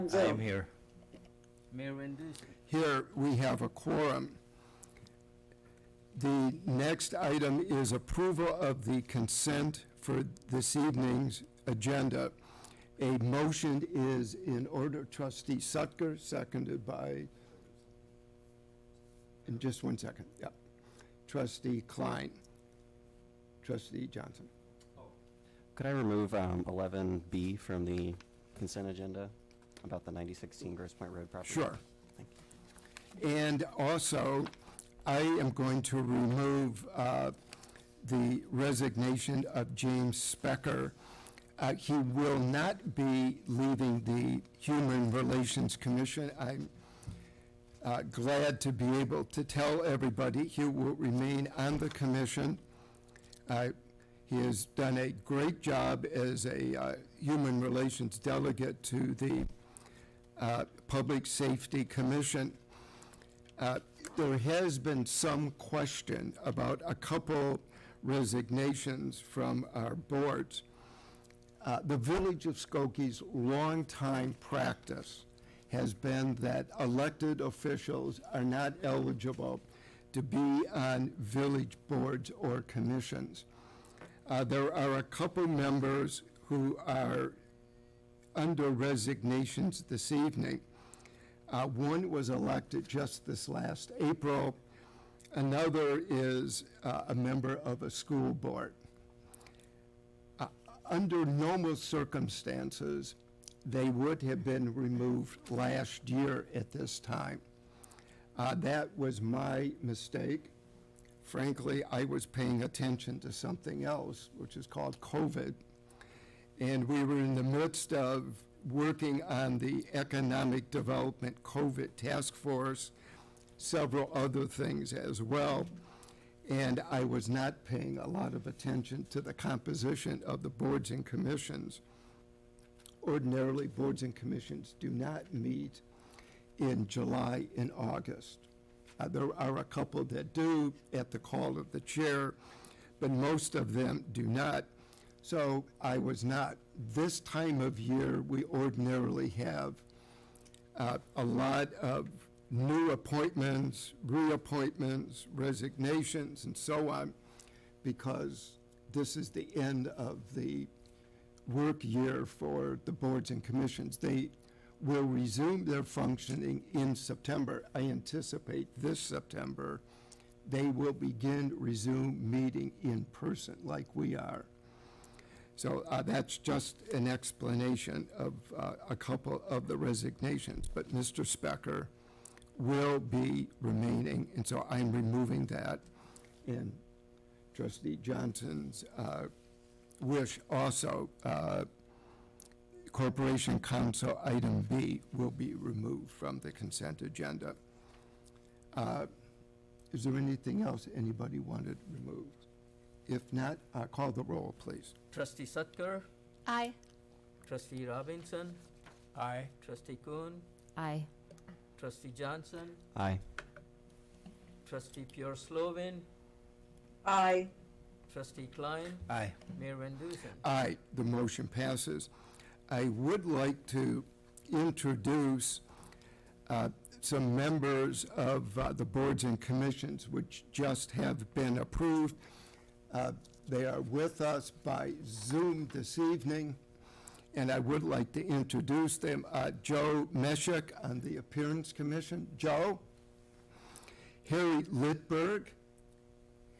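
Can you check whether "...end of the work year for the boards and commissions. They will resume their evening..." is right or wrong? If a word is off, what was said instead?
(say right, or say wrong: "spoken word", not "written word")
wrong: "functioning", not "evening".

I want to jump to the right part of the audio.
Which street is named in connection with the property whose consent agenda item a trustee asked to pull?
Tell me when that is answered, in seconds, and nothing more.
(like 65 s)
30 s.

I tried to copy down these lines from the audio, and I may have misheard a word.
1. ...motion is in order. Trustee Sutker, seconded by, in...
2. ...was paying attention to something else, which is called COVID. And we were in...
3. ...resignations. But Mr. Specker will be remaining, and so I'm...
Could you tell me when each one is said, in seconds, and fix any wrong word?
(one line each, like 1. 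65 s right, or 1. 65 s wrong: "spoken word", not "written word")
1. 13 s right
2. 112 s right
3. 179 s right.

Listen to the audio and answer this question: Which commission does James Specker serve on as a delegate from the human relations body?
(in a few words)
Public Safety Commission.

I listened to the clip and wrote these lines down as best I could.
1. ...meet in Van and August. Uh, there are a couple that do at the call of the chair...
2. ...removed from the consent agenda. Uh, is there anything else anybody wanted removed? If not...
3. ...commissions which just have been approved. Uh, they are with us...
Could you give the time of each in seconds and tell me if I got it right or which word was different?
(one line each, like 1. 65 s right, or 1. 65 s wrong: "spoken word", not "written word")
1. 135 s wrong: "July", not "Van"
2. 195 s right
3. 229 s right.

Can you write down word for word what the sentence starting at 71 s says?
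Uh, the Village of Skokie's longtime practice has been that elected officials are not eligible to be on village boards or commissions.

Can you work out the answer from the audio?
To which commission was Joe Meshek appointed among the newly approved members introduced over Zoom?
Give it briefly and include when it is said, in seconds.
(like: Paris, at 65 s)
Appearance Commission, at 241 s.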